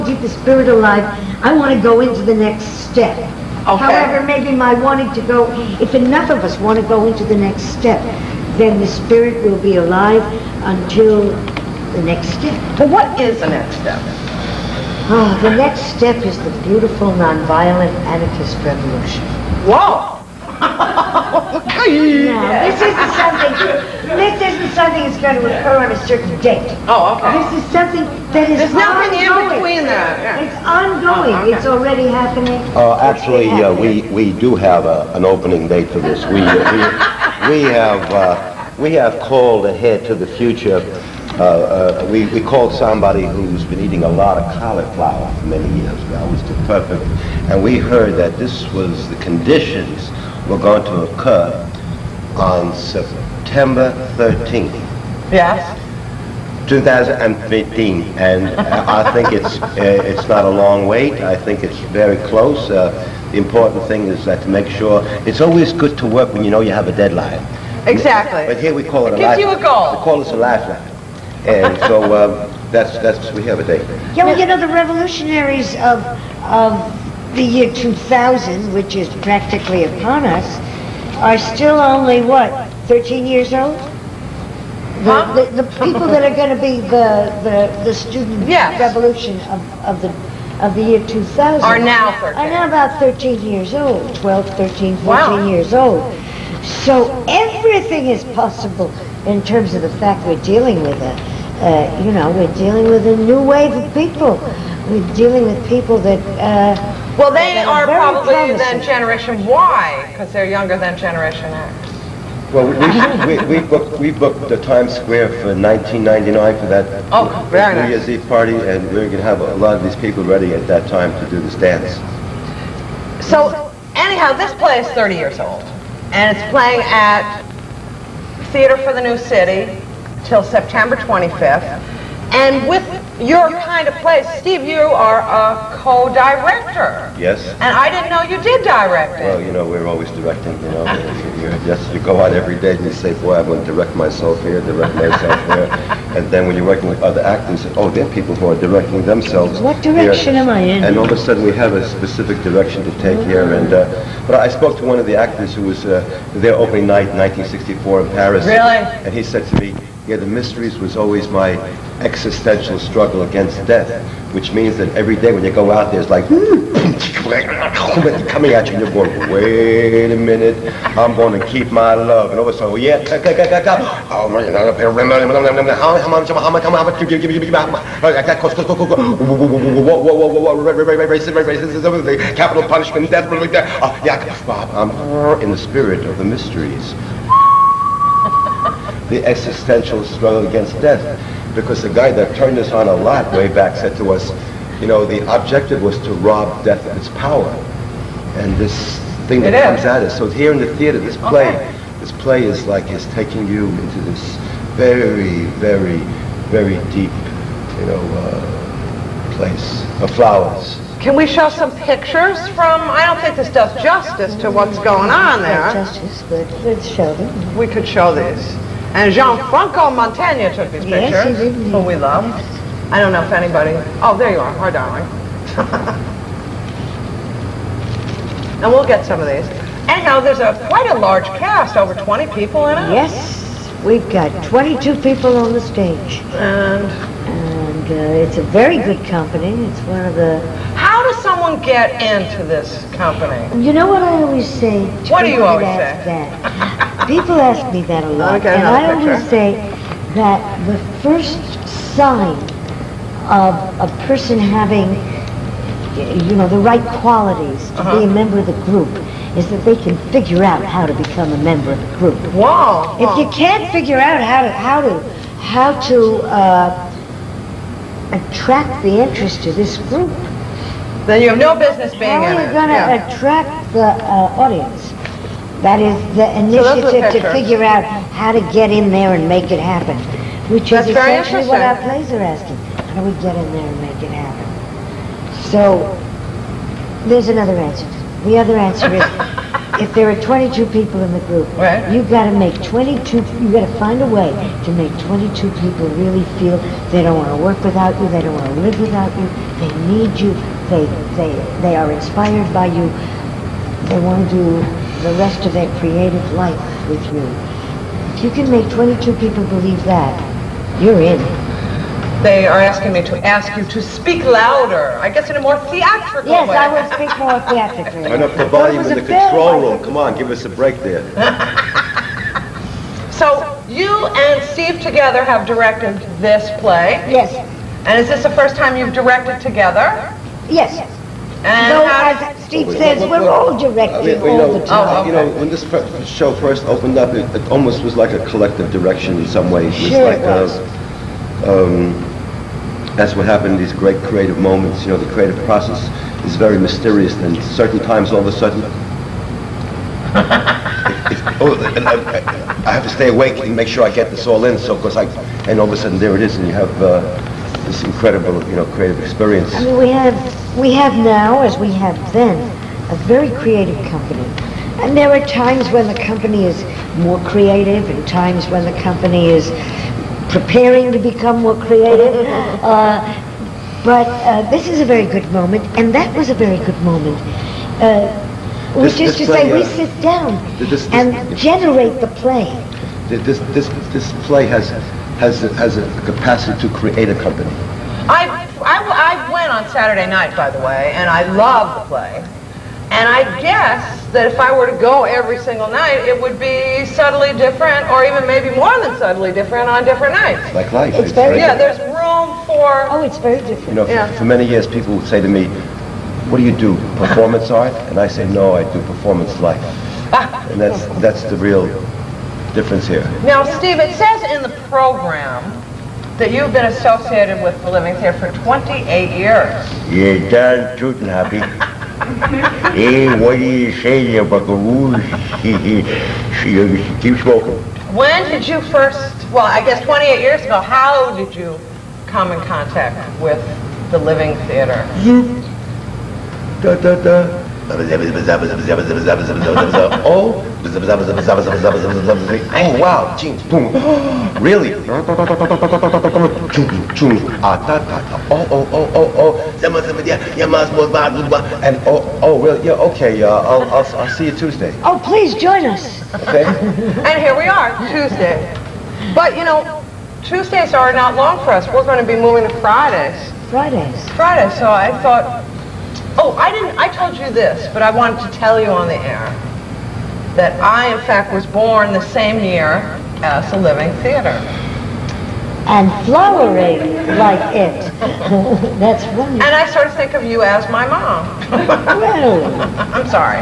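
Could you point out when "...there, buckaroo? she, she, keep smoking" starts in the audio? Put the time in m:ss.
7:04.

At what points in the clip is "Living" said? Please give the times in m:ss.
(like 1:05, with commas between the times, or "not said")
6:57, 7:13, 7:53.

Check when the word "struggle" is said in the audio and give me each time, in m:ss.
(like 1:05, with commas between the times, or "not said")
2:42, 3:10.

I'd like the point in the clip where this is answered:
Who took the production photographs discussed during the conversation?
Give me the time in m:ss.
3:39.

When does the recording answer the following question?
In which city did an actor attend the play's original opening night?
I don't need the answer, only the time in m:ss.
2:38.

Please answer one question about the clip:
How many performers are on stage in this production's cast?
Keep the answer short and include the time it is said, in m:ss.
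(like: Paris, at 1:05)
22, at 3:54.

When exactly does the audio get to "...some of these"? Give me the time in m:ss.
3:49.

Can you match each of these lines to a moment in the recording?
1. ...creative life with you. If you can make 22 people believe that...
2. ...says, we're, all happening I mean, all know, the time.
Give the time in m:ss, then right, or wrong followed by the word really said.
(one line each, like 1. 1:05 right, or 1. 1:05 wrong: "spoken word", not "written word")
1. 5:05 right
2. 5:32 wrong: "directing", not "happening".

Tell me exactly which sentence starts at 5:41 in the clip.
um, that's what happened in these great creative moments.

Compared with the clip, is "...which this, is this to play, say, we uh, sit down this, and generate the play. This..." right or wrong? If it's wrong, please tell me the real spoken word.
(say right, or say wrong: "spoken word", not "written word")
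right.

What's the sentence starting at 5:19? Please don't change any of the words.
Come on, give us a break there.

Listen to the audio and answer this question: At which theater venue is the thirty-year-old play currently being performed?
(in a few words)
Theater for the New City.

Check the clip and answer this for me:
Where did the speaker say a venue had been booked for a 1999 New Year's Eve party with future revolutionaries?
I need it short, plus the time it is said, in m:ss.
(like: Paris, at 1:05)
Times Square, at 1:54.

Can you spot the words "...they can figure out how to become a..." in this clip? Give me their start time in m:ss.
4:19.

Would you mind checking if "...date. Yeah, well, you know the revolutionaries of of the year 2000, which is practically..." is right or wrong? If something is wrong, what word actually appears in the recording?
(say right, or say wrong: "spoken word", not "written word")
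right.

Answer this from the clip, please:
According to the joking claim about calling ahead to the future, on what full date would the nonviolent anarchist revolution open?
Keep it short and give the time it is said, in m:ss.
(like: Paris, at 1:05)
September 13, 2015, at 0:53.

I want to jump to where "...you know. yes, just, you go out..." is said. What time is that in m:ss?
2:20.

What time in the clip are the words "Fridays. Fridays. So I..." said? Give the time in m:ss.
7:43.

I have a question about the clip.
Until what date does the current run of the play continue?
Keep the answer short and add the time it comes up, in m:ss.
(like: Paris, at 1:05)
September 25, at 2:10.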